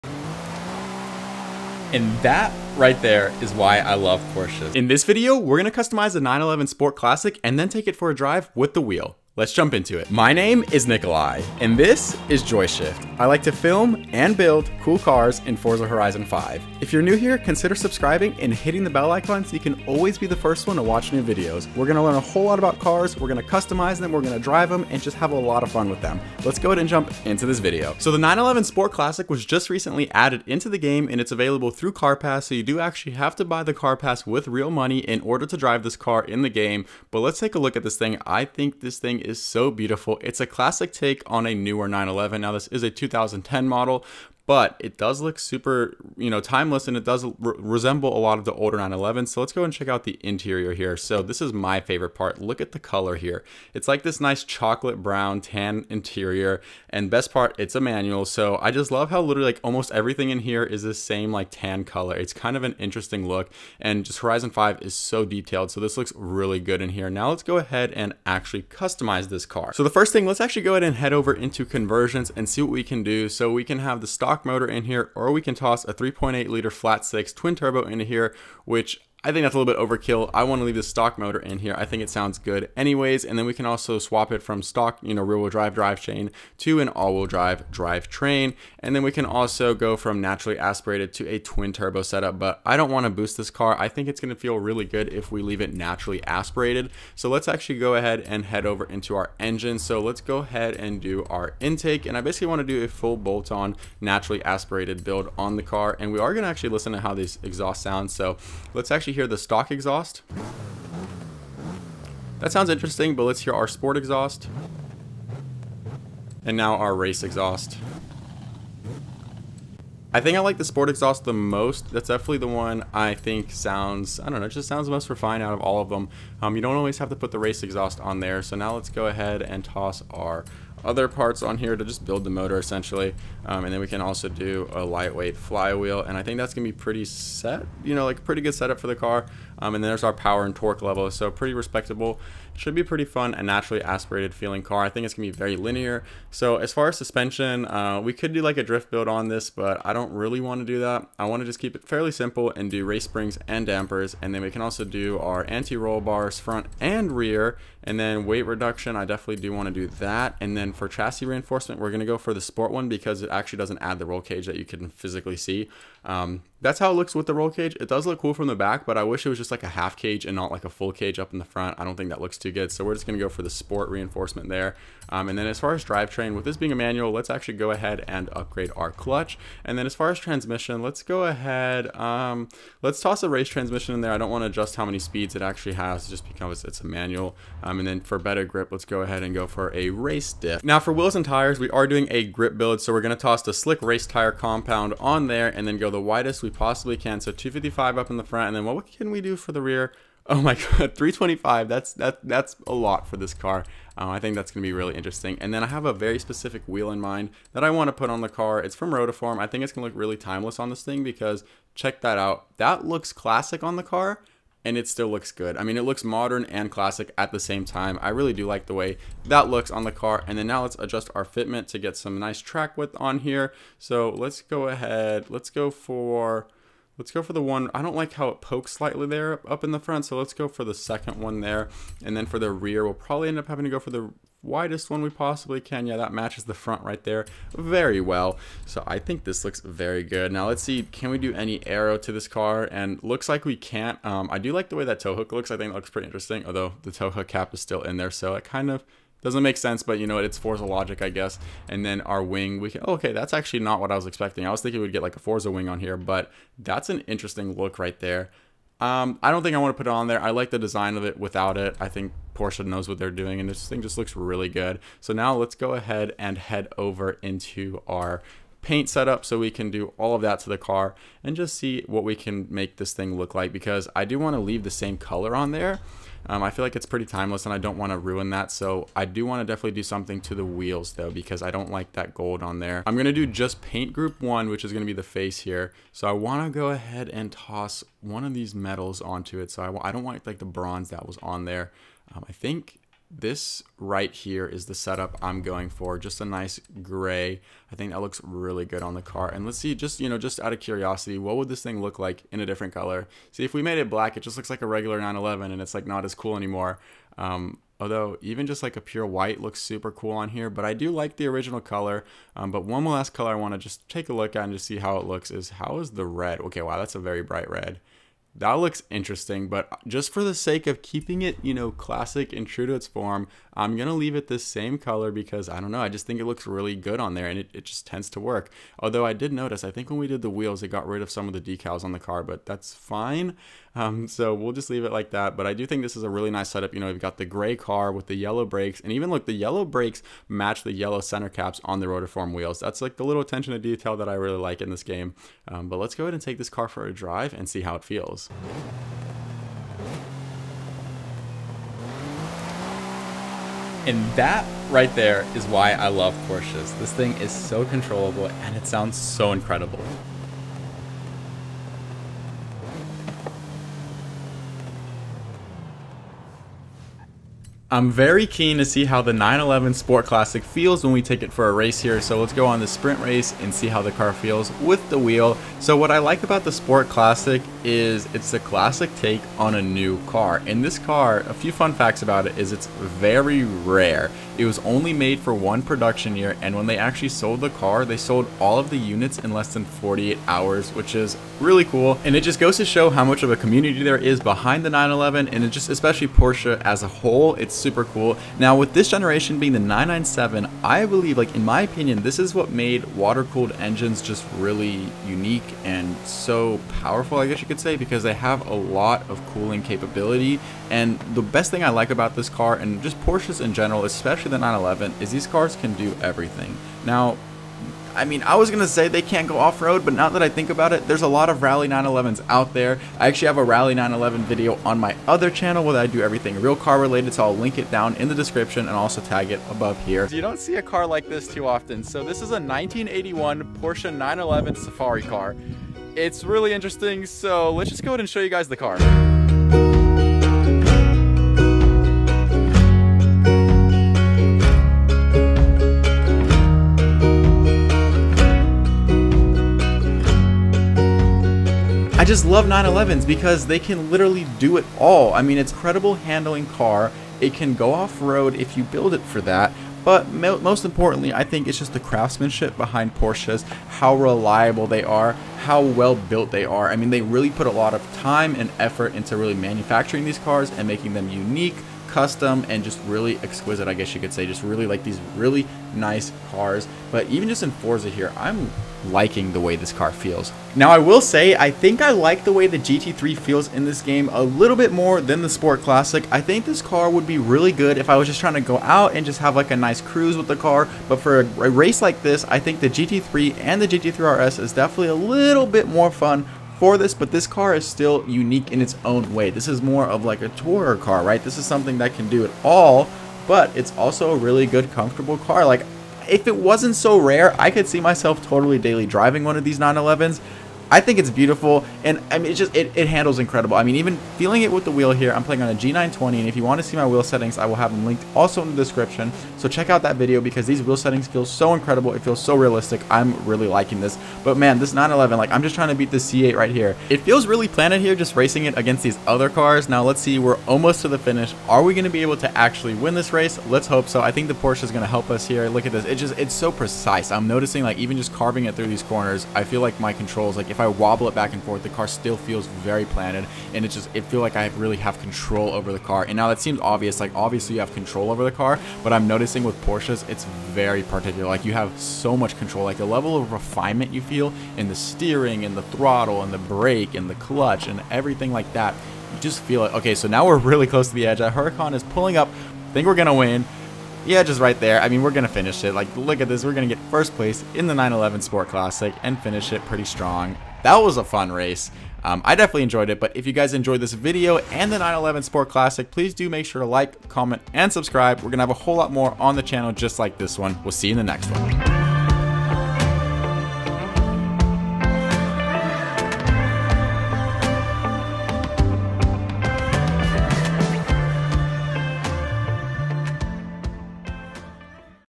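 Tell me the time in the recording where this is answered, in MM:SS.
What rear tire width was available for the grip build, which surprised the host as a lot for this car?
03:20.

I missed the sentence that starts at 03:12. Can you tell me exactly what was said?
So we're gonna toss the slick race tire compound on there and then go the widest we possibly can.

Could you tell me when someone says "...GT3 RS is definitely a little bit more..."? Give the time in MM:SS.
08:13.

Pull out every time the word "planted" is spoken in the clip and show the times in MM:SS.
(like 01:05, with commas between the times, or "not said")
08:47, 09:02.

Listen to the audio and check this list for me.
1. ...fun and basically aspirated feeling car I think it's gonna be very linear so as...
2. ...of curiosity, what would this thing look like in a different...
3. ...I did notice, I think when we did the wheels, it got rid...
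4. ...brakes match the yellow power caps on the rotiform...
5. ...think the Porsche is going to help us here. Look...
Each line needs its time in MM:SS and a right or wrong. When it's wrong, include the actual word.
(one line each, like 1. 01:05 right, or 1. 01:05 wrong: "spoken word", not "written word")
1. 02:23 wrong: "naturally", not "basically"
2. 05:00 right
3. 05:29 right
4. 05:39 wrong: "center", not "power"
5. 08:54 right.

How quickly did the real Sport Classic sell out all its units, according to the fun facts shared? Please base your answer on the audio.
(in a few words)
Less than 48 hours.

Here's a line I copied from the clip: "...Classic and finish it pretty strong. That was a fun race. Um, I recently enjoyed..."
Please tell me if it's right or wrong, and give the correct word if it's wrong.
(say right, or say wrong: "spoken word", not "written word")
wrong: "definitely", not "recently".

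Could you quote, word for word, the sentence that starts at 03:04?
I don't wanna adjust how many speeds it actually has just because it's a manual.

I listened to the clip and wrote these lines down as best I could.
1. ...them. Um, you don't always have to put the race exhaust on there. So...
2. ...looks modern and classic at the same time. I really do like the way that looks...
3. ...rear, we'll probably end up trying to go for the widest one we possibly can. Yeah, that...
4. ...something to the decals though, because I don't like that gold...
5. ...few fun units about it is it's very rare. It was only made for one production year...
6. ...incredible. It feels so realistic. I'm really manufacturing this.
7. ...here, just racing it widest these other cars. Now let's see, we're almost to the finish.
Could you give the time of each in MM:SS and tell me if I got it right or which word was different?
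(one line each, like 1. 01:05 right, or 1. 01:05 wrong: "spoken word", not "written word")
1. 02:05 right
2. 03:35 right
3. 03:52 wrong: "having", not "trying"
4. 04:39 wrong: "wheels", not "decals"
5. 06:21 wrong: "facts", not "units"
6. 08:41 wrong: "liking", not "manufacturing"
7. 08:47 wrong: "against", not "widest".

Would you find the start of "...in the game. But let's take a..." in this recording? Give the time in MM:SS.
00:36.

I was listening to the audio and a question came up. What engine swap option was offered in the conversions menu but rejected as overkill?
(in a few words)
3.8 liter flat six twin turbo.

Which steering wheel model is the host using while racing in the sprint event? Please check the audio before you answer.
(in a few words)
G920.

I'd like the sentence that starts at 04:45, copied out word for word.
So I want to go ahead and toss one of these metals onto it.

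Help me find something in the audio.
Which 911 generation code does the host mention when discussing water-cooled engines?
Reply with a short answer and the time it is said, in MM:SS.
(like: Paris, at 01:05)
997, at 06:39.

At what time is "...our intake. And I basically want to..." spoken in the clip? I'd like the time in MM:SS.
01:41.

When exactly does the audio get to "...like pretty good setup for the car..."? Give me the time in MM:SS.
02:18.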